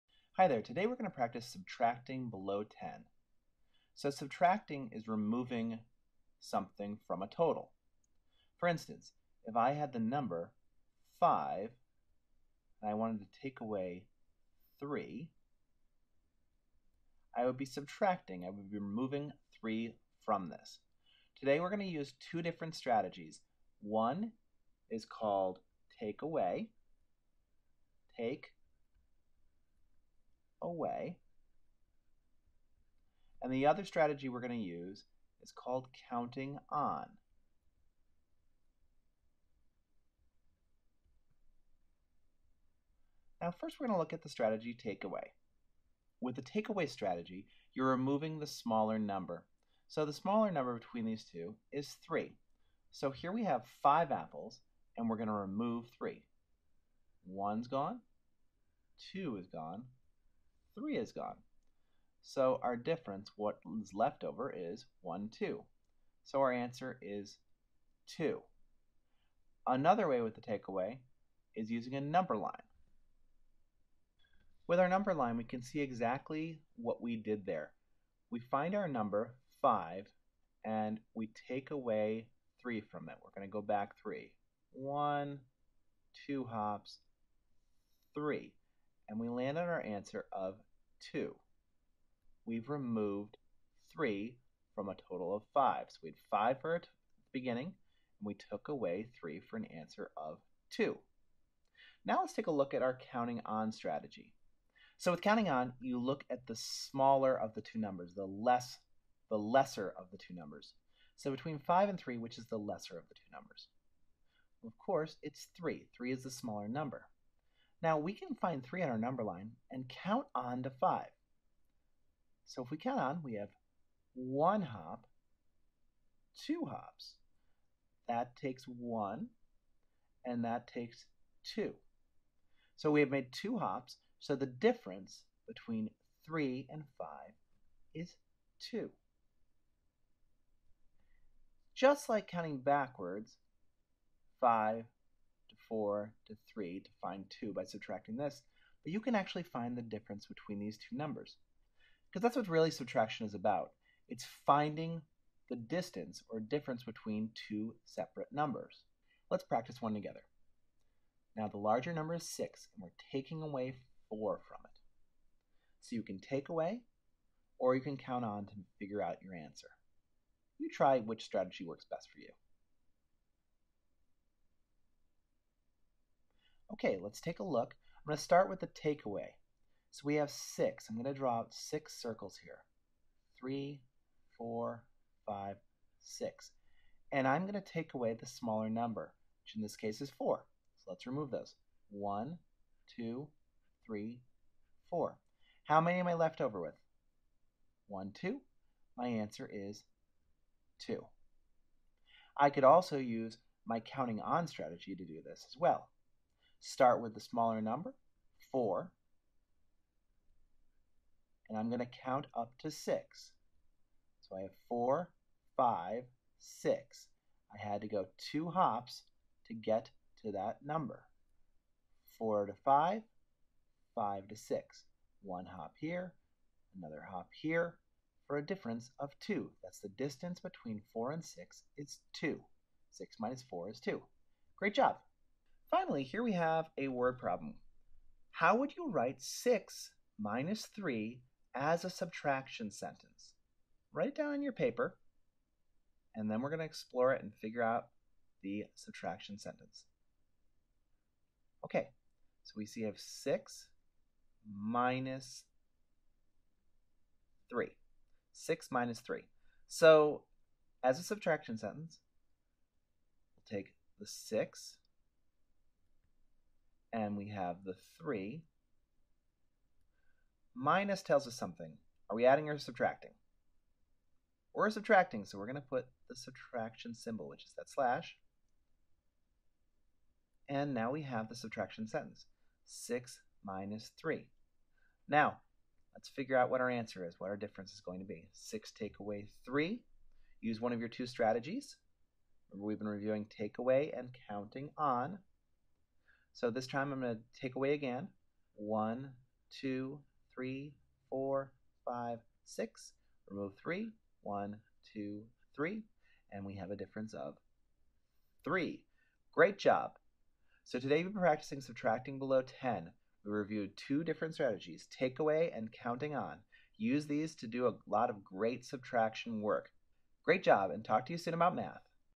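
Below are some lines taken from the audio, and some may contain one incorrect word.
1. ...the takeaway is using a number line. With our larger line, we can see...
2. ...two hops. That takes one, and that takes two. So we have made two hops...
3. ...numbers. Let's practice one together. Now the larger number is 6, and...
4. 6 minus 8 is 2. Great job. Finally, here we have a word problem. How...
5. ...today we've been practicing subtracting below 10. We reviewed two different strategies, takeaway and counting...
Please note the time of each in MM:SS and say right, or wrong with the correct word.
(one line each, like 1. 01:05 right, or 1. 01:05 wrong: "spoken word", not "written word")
1. 01:10 wrong: "number", not "larger"
2. 02:06 right
3. 02:38 right
4. 03:52 wrong: "4", not "8"
5. 05:10 right.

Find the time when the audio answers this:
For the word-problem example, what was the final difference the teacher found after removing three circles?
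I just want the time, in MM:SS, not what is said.
05:06.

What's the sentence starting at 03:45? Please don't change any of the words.
One hop here, another hop here, for a difference of 2.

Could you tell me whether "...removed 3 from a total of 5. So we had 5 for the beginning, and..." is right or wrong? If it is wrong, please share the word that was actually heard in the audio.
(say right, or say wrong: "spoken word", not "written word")
right.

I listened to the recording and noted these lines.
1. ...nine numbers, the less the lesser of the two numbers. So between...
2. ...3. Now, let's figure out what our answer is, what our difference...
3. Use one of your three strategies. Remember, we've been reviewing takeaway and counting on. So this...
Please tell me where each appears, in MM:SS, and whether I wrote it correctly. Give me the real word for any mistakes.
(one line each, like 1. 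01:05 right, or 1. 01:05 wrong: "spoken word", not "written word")
1. 01:47 wrong: "two", not "nine"
2. 04:43 right
3. 04:50 wrong: "two", not "three".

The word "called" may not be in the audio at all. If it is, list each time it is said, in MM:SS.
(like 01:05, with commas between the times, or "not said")
00:25, 00:35.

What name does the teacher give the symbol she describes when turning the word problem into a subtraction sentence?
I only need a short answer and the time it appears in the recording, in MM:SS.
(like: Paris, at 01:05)
slash, at 04:37.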